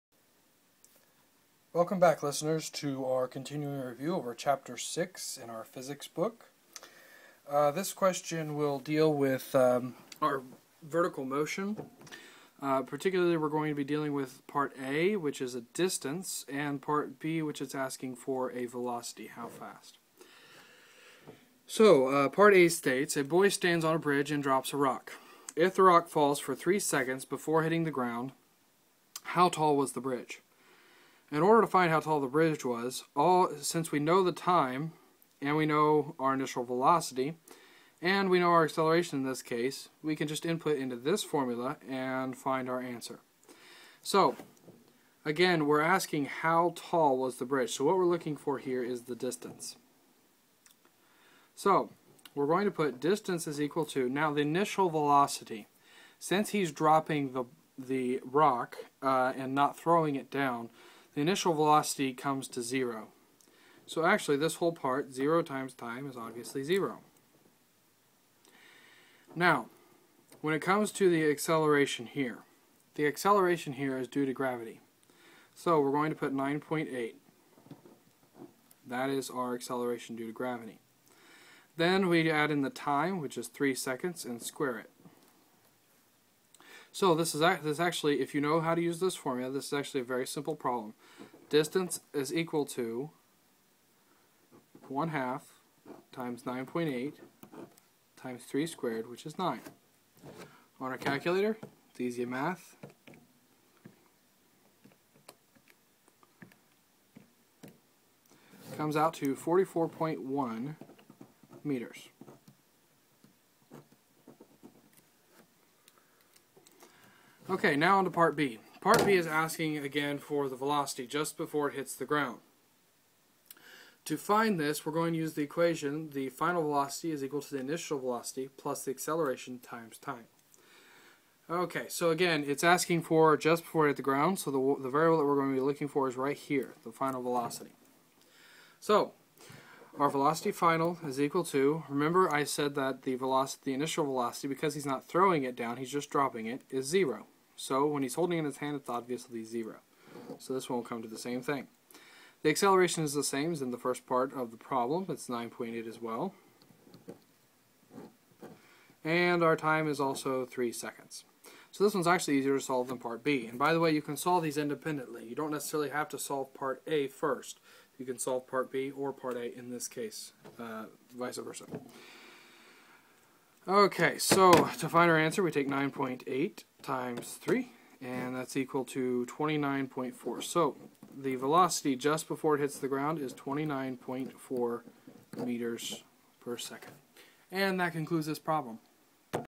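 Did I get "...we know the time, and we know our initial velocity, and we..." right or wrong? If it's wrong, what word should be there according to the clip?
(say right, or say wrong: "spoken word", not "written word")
right.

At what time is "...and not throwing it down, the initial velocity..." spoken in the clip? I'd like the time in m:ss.
0:59.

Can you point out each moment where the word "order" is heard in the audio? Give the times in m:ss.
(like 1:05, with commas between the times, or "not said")
0:31.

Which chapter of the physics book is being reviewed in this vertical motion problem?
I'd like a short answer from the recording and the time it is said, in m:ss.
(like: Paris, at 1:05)
Chapter 6, at 0:04.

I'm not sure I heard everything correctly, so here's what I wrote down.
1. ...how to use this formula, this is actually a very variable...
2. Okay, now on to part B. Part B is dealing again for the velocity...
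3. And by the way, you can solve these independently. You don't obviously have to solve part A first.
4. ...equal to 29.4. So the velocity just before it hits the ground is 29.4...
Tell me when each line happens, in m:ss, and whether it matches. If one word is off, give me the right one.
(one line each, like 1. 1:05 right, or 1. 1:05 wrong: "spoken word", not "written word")
1. 1:28 wrong: "simple", not "variable"
2. 1:57 wrong: "asking", not "dealing"
3. 2:43 wrong: "necessarily", not "obviously"
4. 2:58 right.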